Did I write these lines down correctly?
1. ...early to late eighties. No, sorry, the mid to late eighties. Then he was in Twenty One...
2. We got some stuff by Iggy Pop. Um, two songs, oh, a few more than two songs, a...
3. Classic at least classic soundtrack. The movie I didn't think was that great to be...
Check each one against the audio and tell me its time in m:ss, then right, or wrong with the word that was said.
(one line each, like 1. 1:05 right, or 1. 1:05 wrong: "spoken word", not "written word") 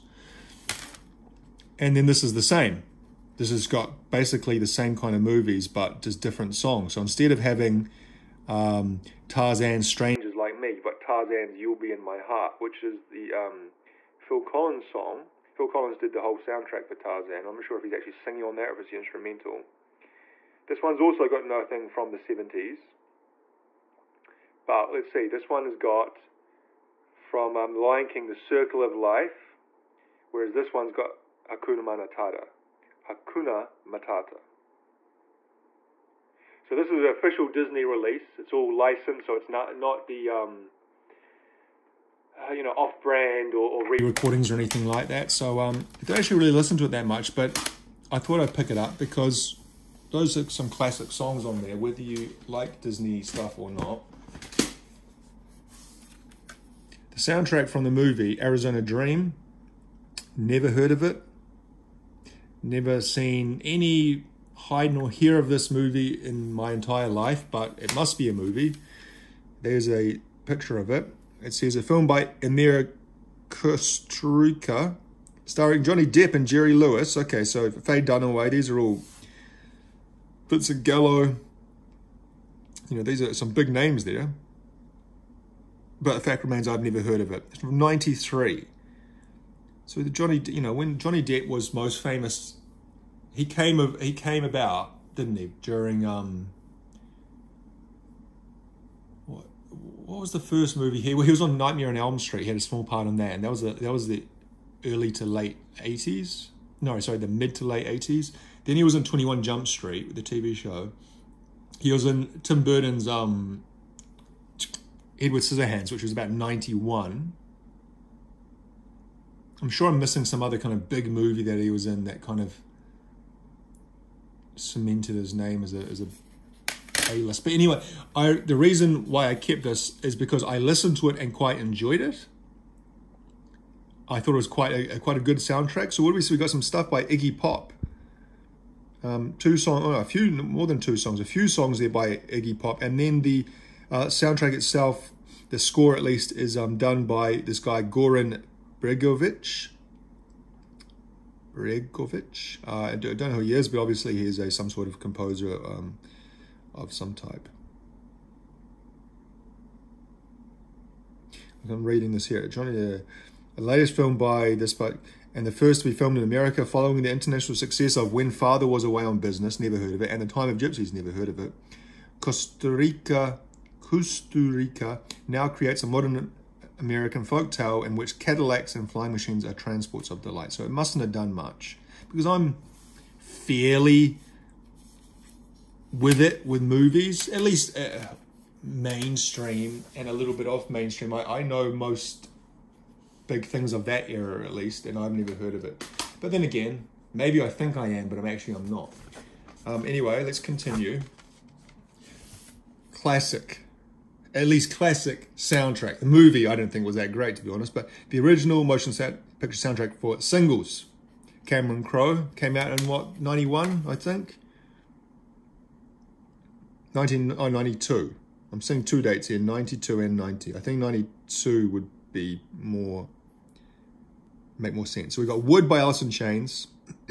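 1. 1:44 right
2. 2:16 right
3. 3:22 right.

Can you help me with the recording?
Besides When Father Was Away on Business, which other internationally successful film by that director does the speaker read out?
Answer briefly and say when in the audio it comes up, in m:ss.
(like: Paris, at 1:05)
The Time of Gypsies, at 2:50.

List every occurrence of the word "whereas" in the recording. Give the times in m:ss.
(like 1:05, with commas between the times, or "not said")
0:30.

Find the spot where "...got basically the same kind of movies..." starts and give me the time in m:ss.
0:03.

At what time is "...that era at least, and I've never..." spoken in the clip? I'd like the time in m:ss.
3:13.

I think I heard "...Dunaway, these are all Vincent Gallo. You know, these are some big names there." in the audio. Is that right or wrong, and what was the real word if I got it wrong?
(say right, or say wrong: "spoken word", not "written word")
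right.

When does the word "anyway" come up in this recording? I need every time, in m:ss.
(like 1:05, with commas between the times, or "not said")
2:07, 3:19.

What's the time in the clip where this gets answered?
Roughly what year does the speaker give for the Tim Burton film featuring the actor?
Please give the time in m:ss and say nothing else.
1:56.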